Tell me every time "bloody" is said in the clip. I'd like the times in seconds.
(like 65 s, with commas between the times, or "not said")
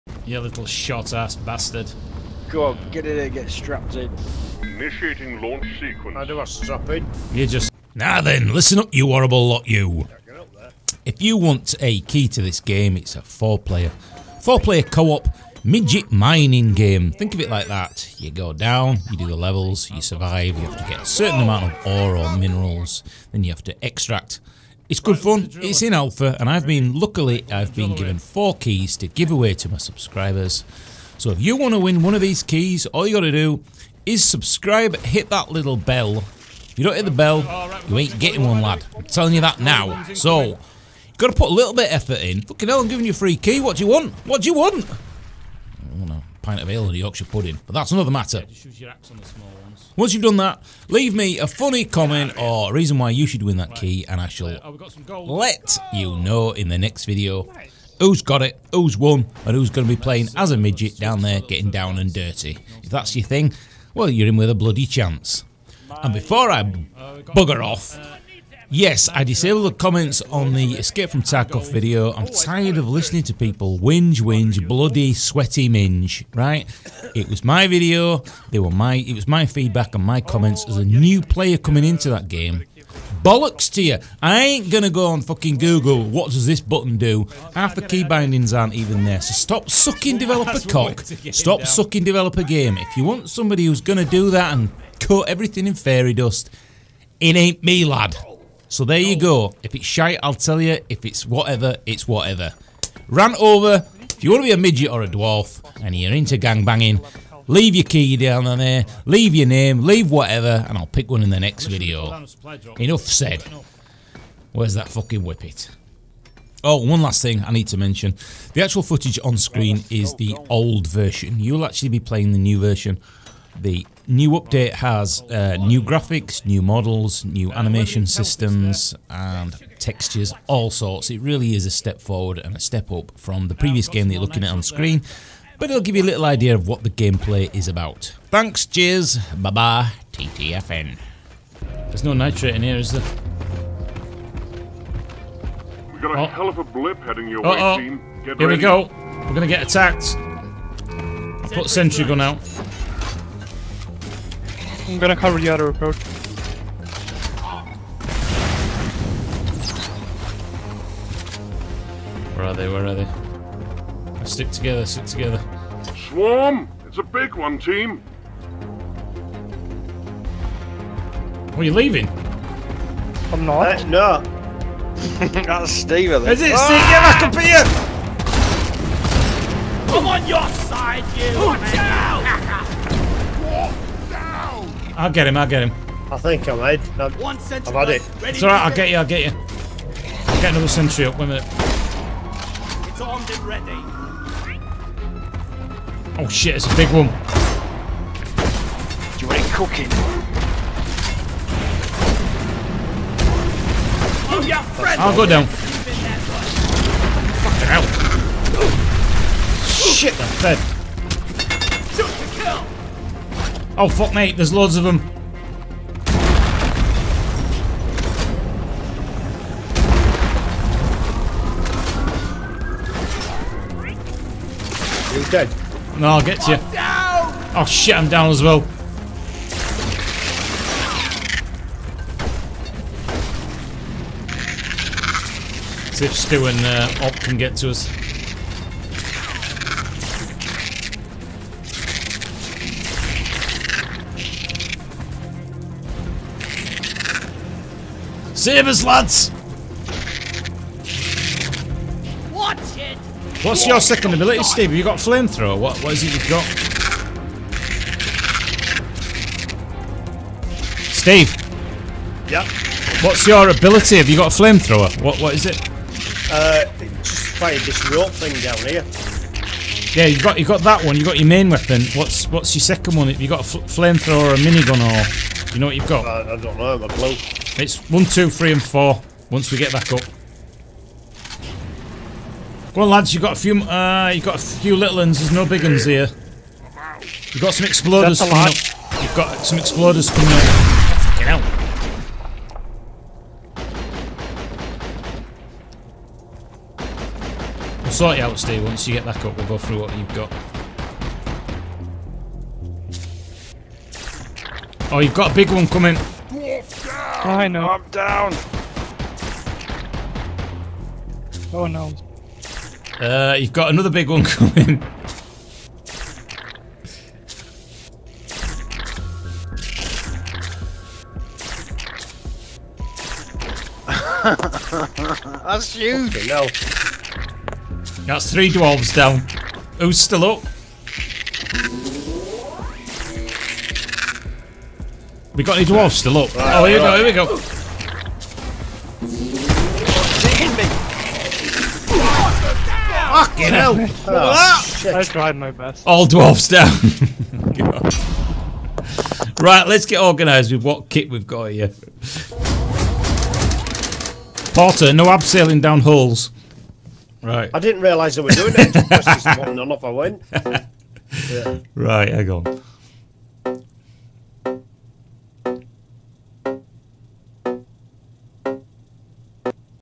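64 s, 74 s.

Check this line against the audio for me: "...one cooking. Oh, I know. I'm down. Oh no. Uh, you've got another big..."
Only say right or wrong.
wrong.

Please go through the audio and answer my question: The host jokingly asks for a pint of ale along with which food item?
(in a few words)
Yorkshire pudding.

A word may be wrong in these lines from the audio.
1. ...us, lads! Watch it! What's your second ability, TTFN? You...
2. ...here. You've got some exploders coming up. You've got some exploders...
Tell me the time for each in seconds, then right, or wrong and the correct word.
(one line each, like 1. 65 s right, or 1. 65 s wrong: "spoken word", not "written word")
1. 248 s wrong: "Steve", not "TTFN"
2. 285 s right.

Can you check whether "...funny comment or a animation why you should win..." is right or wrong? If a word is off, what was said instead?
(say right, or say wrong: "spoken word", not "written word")
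wrong: "reason", not "animation".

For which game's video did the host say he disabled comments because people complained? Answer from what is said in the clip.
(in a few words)
Escape from Tarkov.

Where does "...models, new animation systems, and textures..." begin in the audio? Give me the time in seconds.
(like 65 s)
126 s.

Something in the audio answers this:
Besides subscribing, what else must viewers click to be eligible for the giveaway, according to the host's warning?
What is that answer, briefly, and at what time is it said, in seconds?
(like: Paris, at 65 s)
the bell, at 34 s.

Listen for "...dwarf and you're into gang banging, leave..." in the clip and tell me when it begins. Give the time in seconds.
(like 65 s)
105 s.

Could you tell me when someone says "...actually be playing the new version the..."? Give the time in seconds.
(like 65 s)
121 s.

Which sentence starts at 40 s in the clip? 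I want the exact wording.
So, you got to put a little bit of effort in.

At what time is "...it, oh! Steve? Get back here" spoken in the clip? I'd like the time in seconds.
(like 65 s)
176 s.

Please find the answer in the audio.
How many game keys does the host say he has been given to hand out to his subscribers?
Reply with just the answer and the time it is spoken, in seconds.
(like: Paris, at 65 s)
4, at 28 s.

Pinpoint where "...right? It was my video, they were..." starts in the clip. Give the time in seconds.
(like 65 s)
76 s.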